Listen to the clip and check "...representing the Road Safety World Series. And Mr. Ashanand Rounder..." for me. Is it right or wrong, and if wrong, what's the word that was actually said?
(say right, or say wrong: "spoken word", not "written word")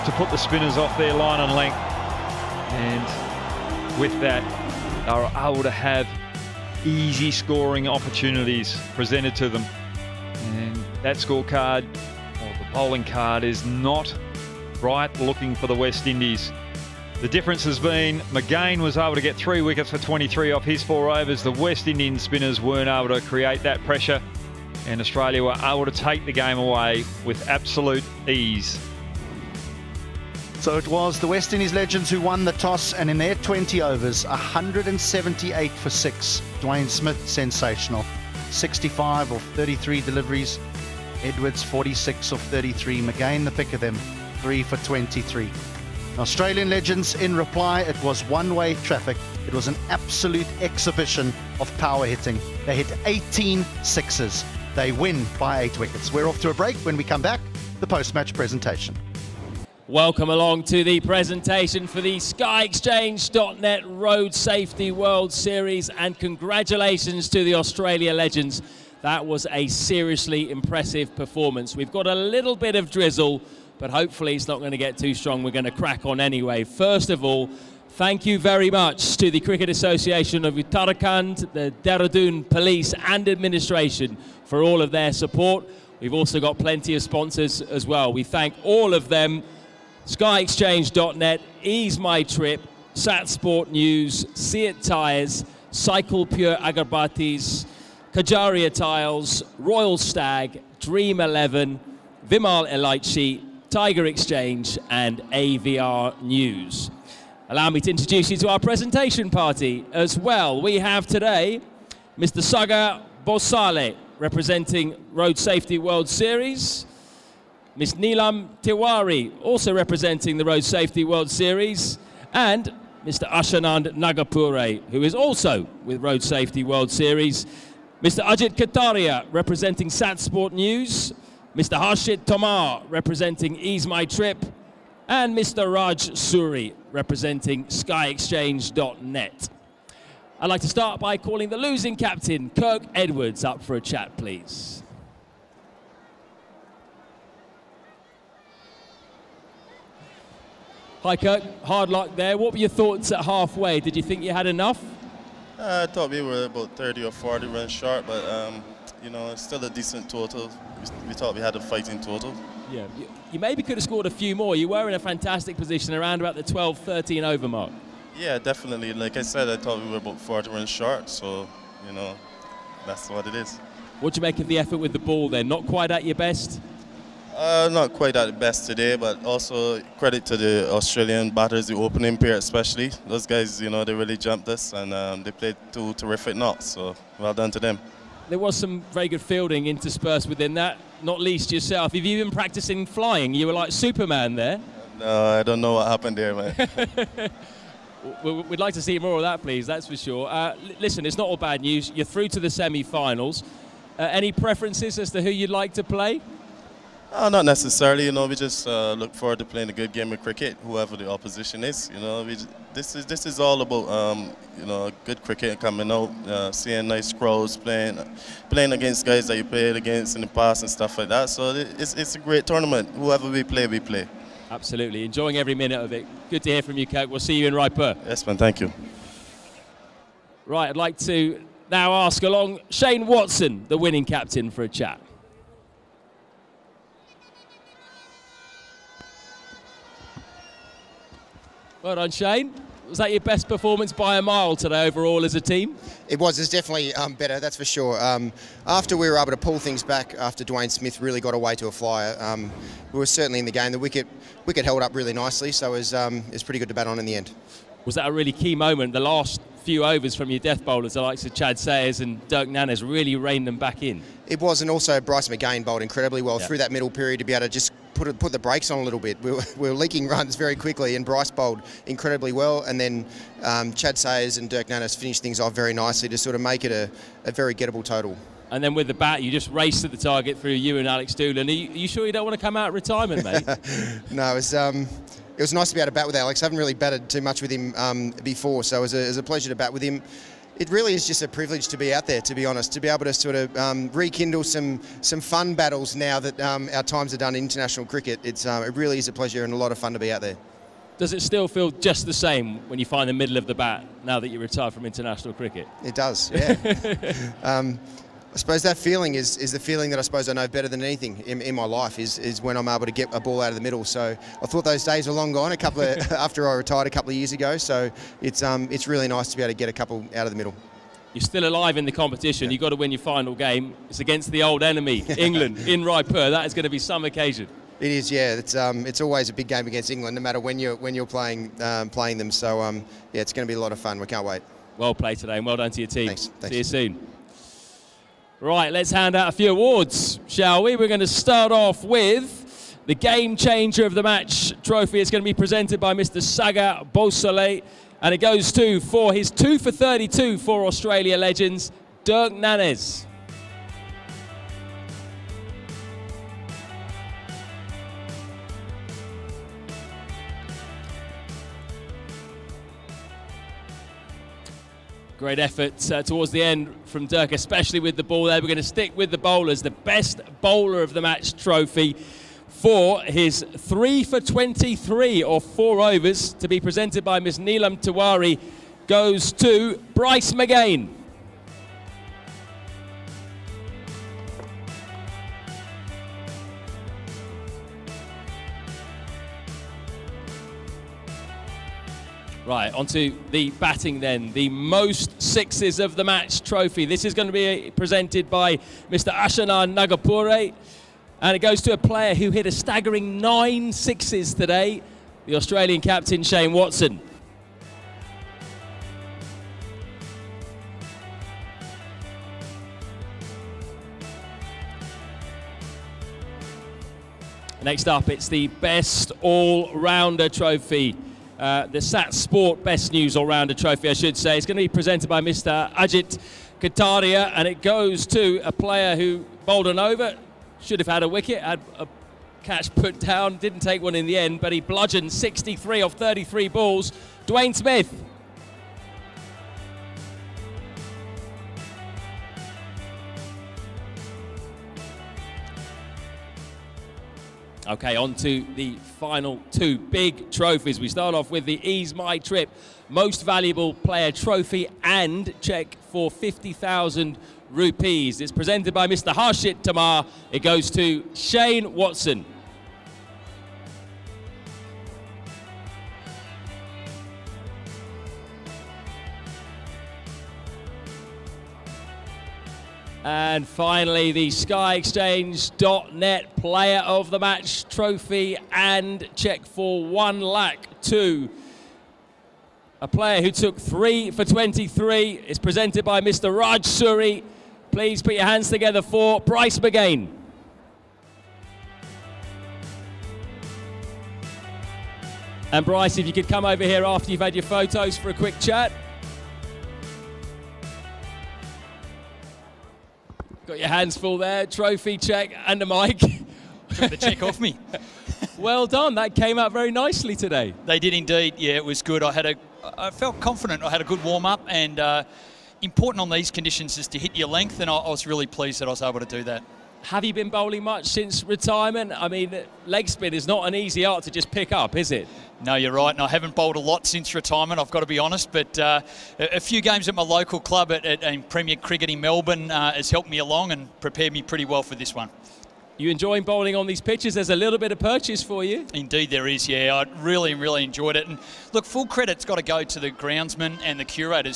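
wrong: "Nagapure", not "Rounder".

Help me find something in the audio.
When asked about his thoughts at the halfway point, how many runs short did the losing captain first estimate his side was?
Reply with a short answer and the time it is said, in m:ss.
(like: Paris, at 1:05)
30 or 40, at 2:36.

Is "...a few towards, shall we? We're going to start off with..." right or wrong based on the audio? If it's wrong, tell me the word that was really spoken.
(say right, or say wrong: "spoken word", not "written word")
wrong: "awards", not "towards".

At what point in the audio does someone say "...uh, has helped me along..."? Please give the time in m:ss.
8:52.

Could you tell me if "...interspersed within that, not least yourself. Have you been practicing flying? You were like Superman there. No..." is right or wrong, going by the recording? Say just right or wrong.
right.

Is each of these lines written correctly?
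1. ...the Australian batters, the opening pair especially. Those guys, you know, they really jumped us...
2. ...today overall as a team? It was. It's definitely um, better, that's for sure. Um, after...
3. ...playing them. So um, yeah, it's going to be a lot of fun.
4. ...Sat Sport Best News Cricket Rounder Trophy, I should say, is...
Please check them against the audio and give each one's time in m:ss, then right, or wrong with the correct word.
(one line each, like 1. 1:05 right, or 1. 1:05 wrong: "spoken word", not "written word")
1. 3:00 right
2. 4:04 right
3. 5:31 right
4. 7:01 wrong: "All", not "Cricket".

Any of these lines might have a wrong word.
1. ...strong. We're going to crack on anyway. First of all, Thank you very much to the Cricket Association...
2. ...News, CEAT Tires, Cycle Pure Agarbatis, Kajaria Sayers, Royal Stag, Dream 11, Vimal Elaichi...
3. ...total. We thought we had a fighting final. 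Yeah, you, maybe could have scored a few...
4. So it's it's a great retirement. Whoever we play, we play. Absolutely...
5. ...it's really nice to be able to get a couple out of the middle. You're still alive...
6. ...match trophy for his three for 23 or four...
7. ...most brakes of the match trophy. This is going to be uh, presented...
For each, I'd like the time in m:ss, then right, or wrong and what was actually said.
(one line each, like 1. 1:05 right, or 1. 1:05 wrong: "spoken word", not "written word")
1. 1:15 right
2. 1:33 wrong: "Tiles", not "Sayers"
3. 2:40 wrong: "total", not "final"
4. 3:41 wrong: "tournament", not "retirement"
5. 5:18 right
6. 6:11 right
7. 6:34 wrong: "sixes", not "brakes".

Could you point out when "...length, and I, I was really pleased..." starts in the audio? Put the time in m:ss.
8:37.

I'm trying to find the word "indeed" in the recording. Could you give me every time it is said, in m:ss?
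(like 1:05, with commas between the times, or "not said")
8:30, 8:58.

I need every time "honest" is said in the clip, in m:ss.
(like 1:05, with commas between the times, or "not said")
4:52, 8:47.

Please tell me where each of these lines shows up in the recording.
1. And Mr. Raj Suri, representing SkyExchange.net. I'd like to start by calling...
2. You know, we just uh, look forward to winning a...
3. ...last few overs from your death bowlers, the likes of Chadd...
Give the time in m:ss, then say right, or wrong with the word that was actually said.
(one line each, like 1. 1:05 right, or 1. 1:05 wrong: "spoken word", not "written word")
1. 2:15 right
2. 3:28 wrong: "playing", not "winning"
3. 4:19 right.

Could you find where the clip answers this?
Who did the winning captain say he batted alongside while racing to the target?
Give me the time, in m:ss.
4:40.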